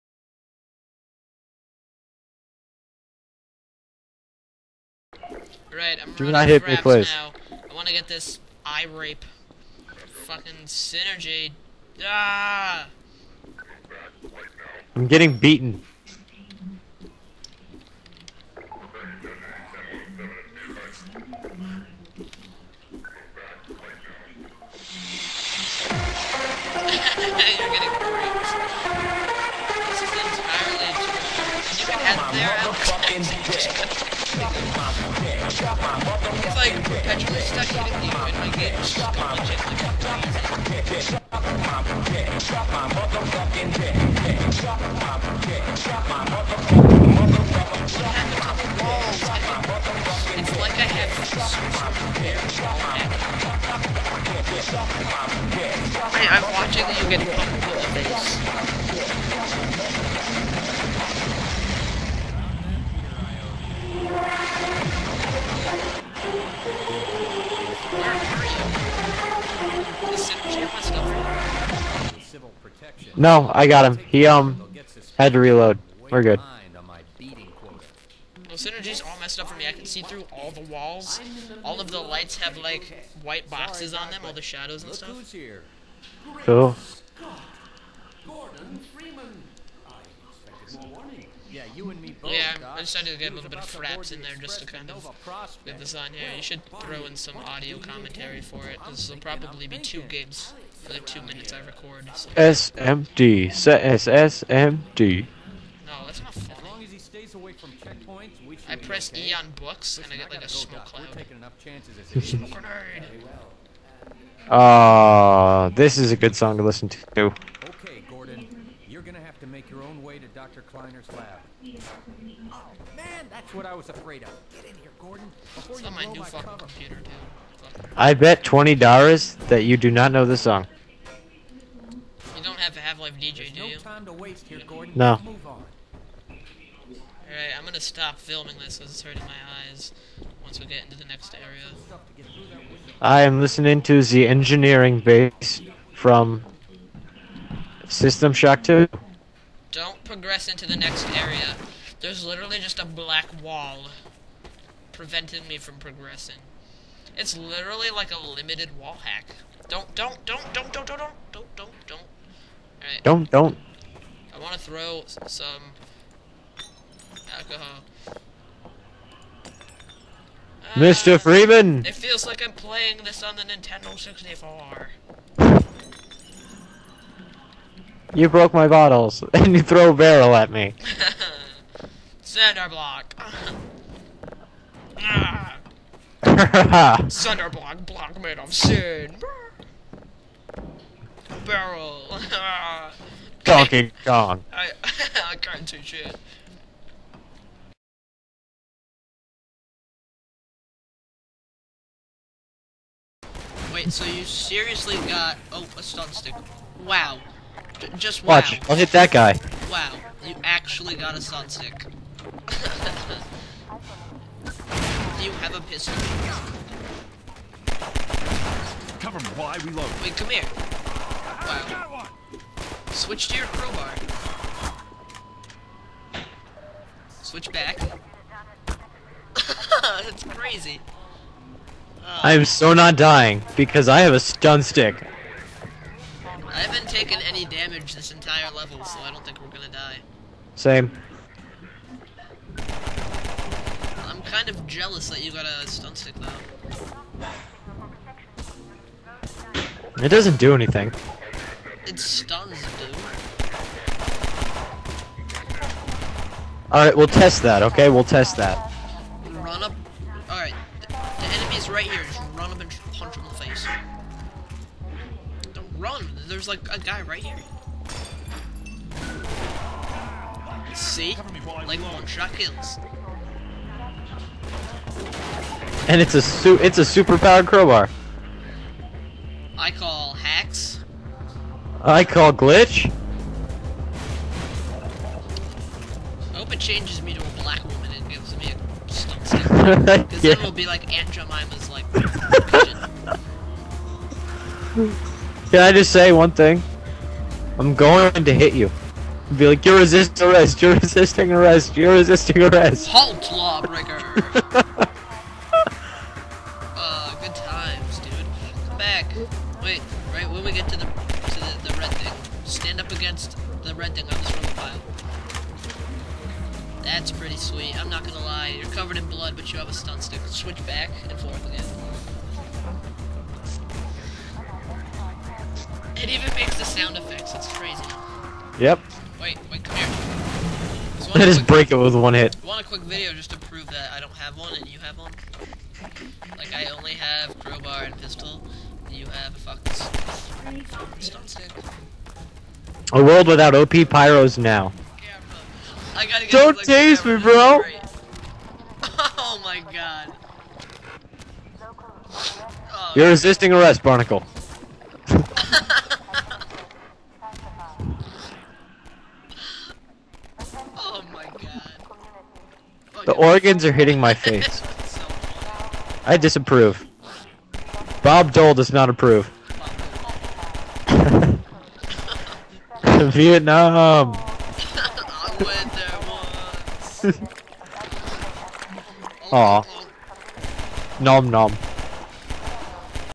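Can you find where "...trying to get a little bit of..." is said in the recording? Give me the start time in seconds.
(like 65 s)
92 s.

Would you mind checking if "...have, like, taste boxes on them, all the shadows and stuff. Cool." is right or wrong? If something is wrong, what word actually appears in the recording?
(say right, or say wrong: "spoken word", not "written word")
wrong: "white", not "taste".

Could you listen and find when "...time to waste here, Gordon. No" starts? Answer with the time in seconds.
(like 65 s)
133 s.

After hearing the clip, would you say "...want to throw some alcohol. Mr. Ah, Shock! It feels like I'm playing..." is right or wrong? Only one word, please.
wrong.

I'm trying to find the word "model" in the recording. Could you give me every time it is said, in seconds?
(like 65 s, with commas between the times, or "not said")
not said.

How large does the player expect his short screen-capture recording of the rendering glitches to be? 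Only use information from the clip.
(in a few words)
2 gigs.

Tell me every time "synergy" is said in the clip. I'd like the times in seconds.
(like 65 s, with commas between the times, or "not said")
10 s, 78 s.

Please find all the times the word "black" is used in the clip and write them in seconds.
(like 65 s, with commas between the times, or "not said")
152 s, 287 s.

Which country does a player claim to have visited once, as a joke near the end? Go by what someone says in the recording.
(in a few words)
Vietnam.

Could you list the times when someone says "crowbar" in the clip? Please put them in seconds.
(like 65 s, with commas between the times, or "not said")
223 s, 277 s, 337 s.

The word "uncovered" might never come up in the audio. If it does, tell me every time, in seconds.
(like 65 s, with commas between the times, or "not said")
not said.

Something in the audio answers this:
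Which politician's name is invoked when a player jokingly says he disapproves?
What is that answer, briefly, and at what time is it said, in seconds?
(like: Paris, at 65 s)
Bob Dole, at 368 s.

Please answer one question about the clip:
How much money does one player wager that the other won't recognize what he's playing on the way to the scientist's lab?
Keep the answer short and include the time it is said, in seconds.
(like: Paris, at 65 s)
$20, at 128 s.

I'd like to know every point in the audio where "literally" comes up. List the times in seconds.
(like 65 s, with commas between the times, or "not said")
152 s, 157 s.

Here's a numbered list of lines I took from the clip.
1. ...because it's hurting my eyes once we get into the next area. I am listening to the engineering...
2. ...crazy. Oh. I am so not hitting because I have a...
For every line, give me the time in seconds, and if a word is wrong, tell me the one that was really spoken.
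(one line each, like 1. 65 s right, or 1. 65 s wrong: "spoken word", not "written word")
1. 138 s right
2. 230 s wrong: "dying", not "hitting".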